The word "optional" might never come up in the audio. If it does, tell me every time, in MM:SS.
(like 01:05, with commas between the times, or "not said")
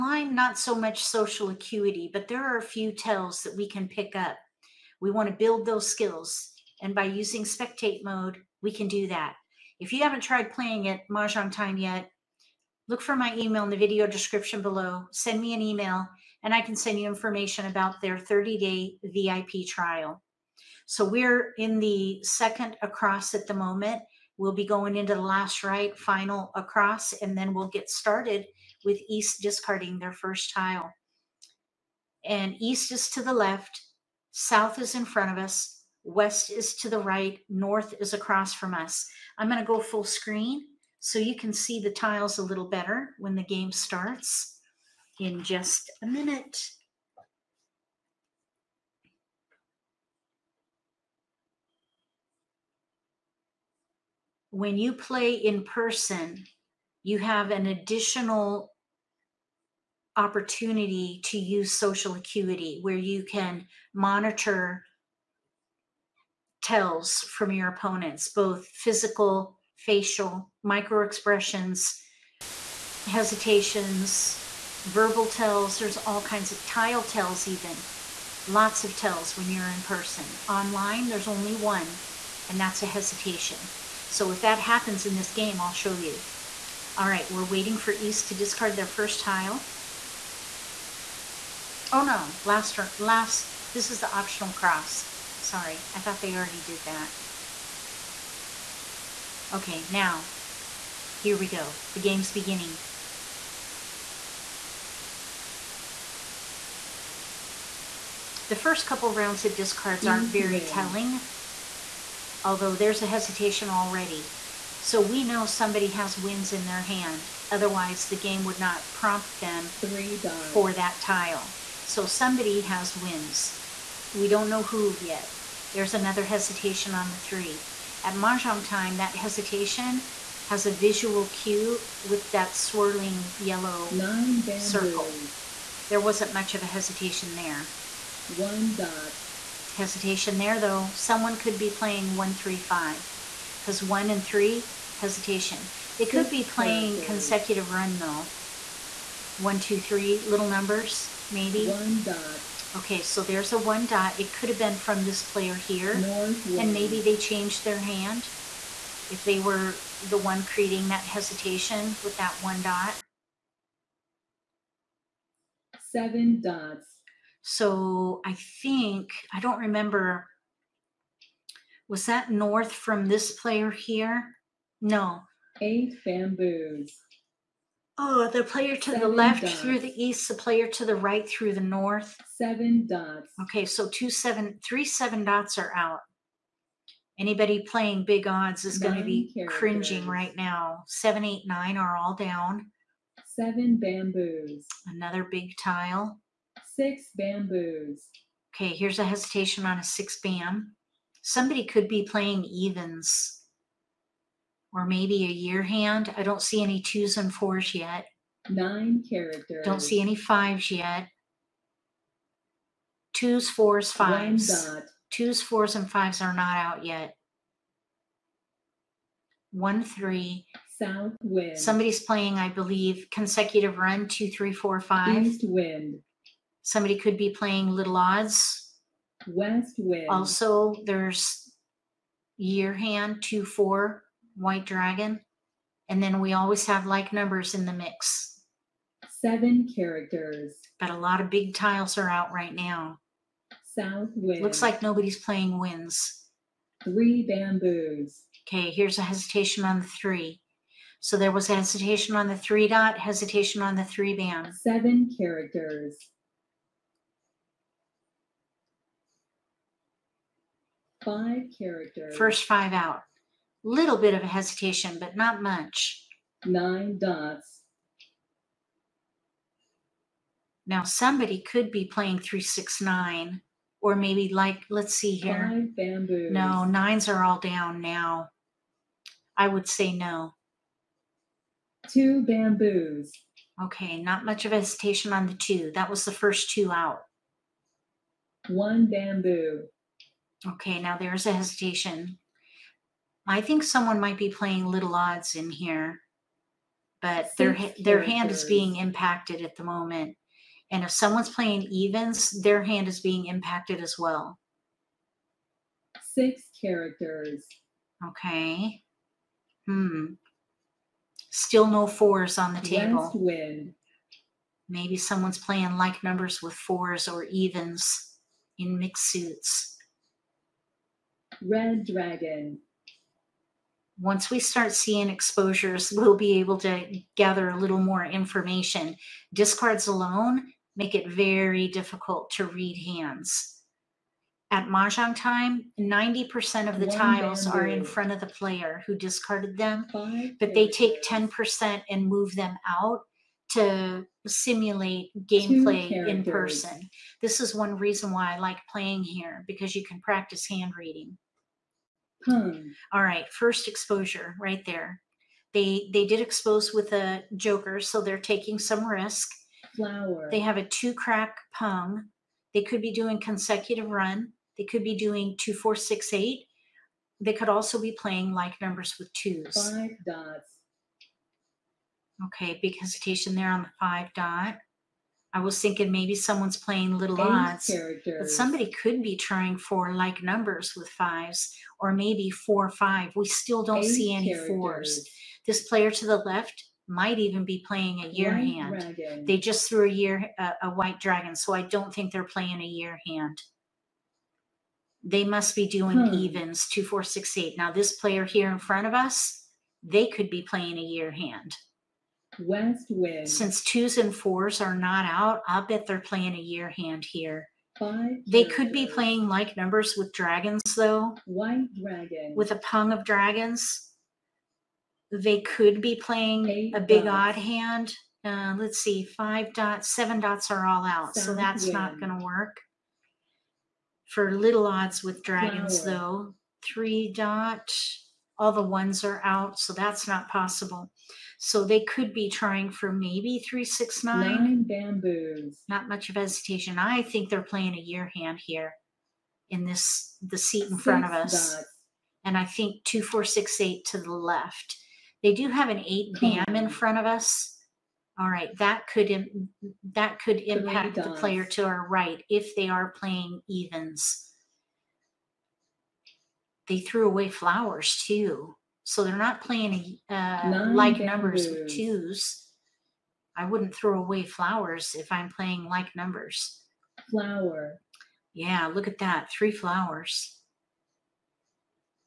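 01:34.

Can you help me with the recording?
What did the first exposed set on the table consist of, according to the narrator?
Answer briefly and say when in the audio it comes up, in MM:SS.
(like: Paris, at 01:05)
two crack pung, at 06:00.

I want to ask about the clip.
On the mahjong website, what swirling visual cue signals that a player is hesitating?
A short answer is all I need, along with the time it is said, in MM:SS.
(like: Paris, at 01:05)
yellow Nine circle, at 02:13.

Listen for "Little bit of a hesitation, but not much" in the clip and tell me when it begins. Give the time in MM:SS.
04:23.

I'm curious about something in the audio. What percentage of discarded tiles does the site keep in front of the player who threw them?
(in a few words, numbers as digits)
90%.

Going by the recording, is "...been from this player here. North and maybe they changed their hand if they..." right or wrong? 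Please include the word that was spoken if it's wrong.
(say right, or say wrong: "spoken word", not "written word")
right.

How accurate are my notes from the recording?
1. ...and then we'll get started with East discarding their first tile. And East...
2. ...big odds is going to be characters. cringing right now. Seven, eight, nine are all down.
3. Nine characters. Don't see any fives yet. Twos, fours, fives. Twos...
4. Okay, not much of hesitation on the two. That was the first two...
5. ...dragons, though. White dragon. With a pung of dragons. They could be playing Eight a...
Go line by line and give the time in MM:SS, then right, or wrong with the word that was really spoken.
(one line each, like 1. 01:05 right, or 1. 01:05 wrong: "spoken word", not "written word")
1. 00:27 right
2. 03:08 right
3. 03:28 right
4. 04:43 right
5. 06:50 right.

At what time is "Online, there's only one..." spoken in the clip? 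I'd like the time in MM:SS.
01:20.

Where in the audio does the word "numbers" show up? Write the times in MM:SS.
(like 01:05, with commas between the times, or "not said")
02:30, 03:57, 05:16, 06:08, 06:20, 06:49, 07:40, 07:45.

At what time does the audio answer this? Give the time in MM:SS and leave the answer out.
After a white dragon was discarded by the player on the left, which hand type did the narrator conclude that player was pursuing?
06:36.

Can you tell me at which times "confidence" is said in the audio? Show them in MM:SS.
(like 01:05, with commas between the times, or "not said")
not said.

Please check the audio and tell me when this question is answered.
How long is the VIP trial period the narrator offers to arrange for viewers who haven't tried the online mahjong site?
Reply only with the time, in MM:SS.
00:18.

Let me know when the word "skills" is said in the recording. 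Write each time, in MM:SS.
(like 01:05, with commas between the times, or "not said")
00:05.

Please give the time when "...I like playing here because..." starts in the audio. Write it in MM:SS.
05:48.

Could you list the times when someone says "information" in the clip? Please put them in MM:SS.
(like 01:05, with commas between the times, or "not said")
00:17, 05:28.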